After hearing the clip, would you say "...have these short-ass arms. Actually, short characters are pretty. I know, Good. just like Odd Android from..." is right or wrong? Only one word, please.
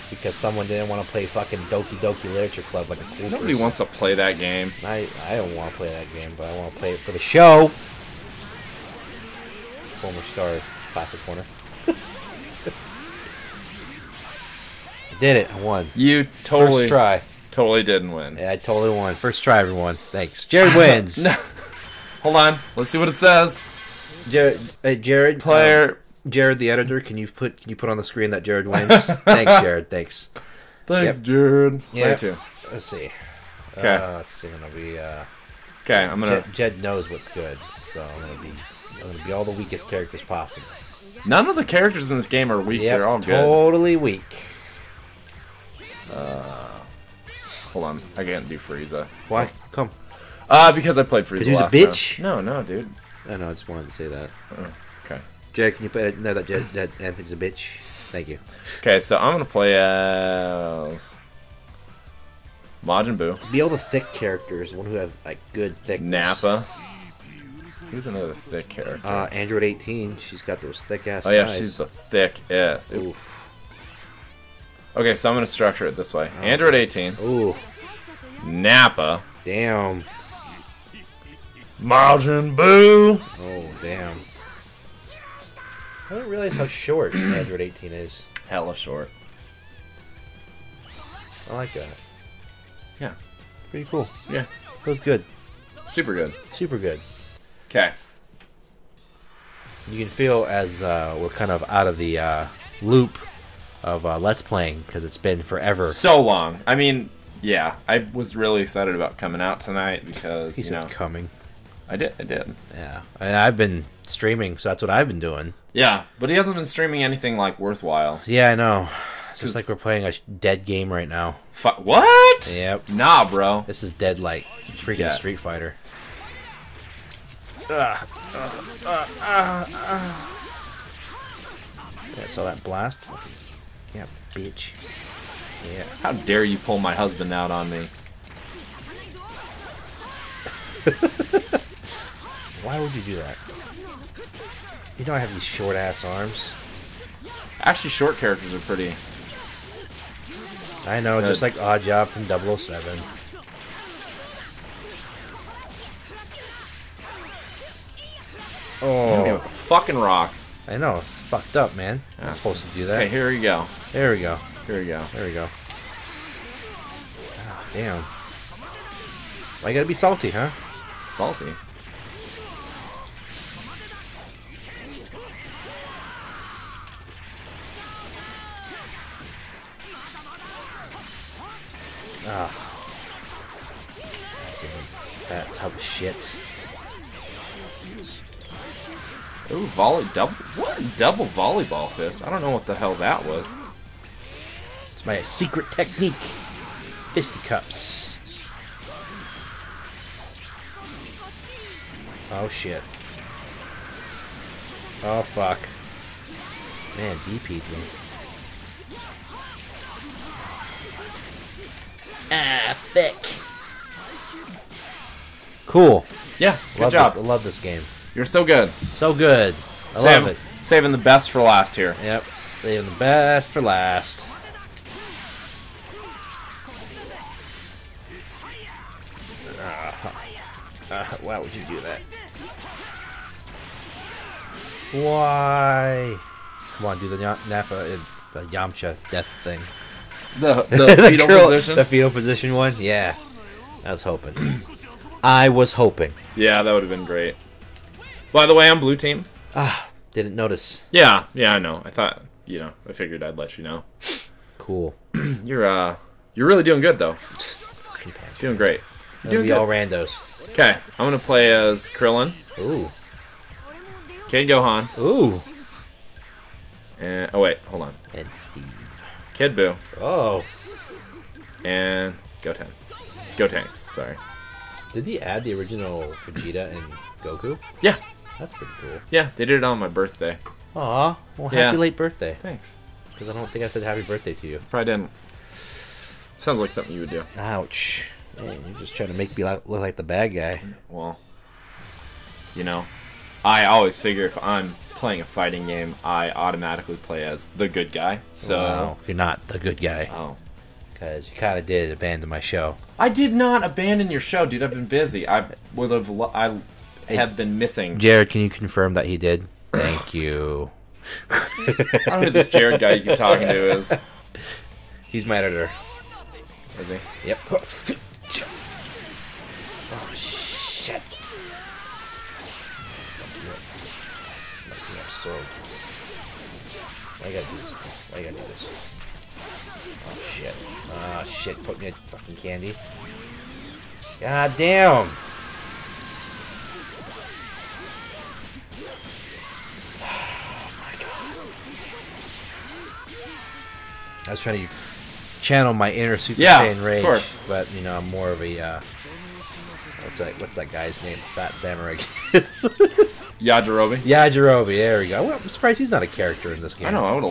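wrong.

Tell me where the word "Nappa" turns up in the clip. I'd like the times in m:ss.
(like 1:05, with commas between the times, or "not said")
1:06, 1:18, 3:57.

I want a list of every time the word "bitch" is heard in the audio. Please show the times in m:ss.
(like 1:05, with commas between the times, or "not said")
0:51, 0:57, 2:14.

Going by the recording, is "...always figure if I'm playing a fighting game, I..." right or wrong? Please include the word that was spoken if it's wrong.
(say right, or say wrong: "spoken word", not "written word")
right.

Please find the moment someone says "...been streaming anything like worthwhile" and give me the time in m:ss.
1:56.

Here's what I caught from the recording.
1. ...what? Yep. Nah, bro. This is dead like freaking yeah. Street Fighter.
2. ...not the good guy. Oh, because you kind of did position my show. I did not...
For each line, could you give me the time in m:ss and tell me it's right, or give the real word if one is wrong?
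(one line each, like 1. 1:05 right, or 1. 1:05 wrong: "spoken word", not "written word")
1. 2:01 right
2. 4:59 wrong: "abandon", not "position".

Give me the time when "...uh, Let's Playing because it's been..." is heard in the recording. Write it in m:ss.
1:44.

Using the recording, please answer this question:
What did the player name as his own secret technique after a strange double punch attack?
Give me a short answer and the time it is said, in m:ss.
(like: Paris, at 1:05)
Fisticuffs, at 3:17.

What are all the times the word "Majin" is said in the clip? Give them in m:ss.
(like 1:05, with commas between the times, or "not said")
1:02, 1:21.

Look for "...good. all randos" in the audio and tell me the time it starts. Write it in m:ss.
4:19.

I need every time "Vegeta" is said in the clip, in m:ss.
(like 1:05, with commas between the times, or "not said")
4:36.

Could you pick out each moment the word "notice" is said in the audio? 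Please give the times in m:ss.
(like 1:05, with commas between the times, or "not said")
4:10.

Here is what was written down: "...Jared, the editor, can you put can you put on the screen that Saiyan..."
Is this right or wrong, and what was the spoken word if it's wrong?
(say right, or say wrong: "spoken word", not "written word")
wrong: "Jared", not "Saiyan".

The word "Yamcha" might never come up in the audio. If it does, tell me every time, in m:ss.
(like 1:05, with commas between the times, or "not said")
3:58.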